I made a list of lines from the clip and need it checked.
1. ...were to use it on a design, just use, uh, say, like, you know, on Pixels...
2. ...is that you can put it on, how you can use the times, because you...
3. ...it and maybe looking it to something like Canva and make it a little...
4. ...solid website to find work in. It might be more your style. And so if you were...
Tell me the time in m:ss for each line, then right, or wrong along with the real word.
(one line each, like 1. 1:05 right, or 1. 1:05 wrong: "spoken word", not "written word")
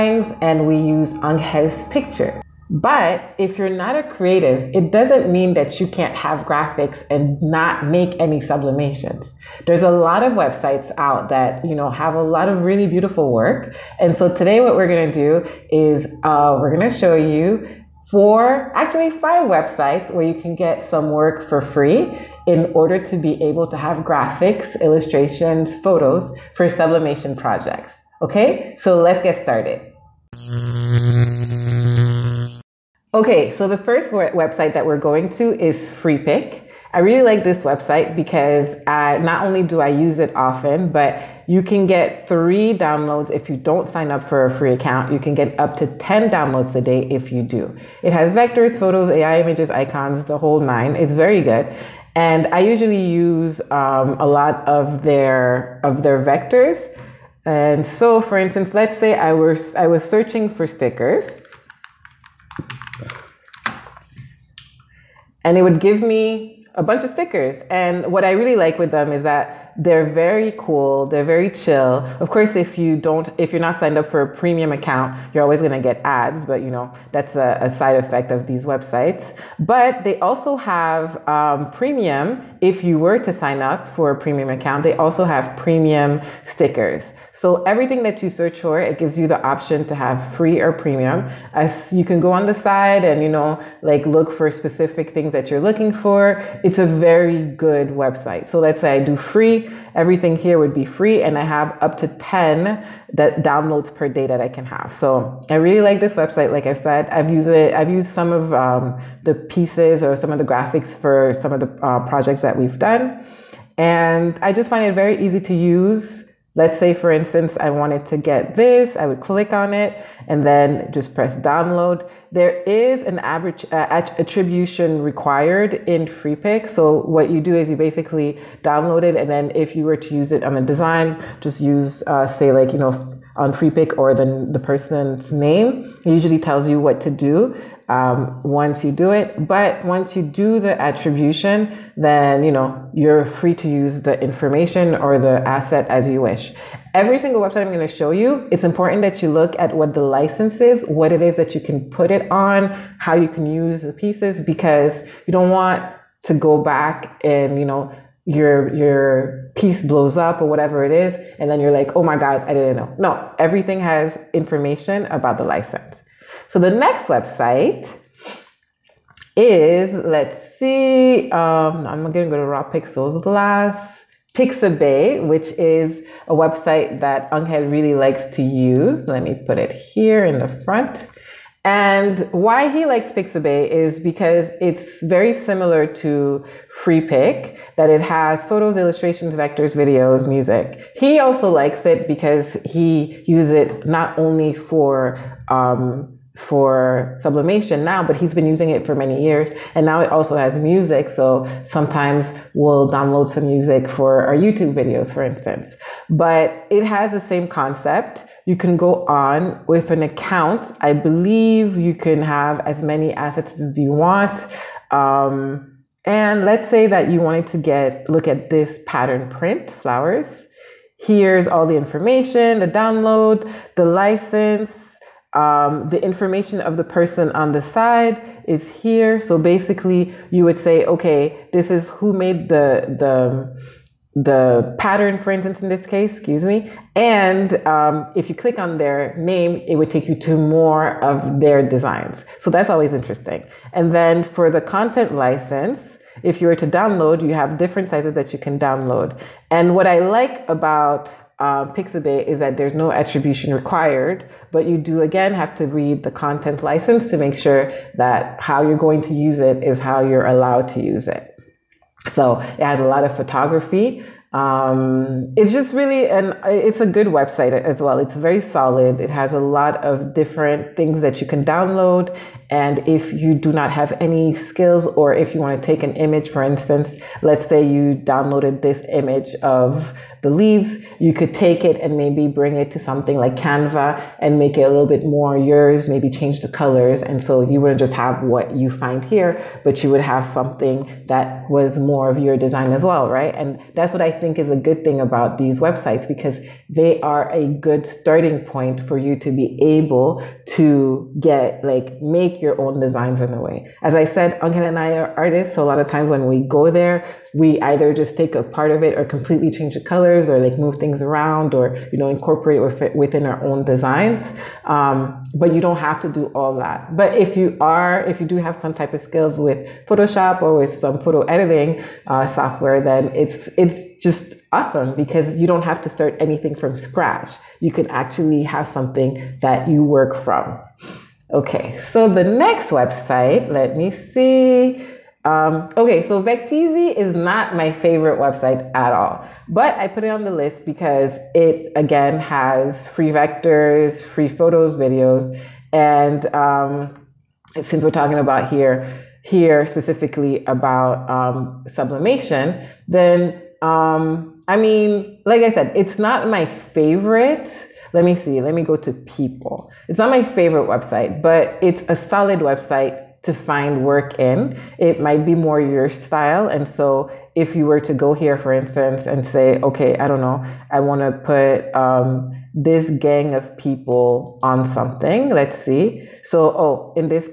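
1. 2:09 wrong: "Freepik", not "Pixels"
2. 2:31 wrong: "pieces", not "times"
3. 4:41 wrong: "bring", not "looking"
4. 6:01 right.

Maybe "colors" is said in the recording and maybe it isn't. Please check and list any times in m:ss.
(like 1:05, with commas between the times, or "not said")
4:46, 5:09.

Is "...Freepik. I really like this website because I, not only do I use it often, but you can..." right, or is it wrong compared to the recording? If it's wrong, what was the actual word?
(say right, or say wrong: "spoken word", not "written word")
right.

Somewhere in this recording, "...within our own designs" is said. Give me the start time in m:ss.
5:13.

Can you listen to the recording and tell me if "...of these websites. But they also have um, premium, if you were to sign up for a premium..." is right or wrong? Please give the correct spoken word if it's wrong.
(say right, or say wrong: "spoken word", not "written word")
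right.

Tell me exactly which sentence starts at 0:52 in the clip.
And I usually use um, a lot of their, of their vectors.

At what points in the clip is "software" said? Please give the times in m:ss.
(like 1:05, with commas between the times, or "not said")
5:22.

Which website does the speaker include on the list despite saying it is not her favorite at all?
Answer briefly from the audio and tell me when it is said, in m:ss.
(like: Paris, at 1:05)
Vecteezy, at 5:36.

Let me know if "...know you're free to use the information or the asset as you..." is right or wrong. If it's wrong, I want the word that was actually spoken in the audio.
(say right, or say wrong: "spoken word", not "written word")
right.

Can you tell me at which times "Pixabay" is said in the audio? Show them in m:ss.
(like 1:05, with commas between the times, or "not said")
2:54, 3:03, 4:11.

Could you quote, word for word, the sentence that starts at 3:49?
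So basically, you would say, okay, this is who made the the the pattern, for instance, in this case, excuse me.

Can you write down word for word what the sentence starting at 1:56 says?
Let's say, for instance, I wanted to get this, I would click on it and then just press download.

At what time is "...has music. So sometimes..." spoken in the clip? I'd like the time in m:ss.
3:20.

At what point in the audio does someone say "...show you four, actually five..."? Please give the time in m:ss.
0:16.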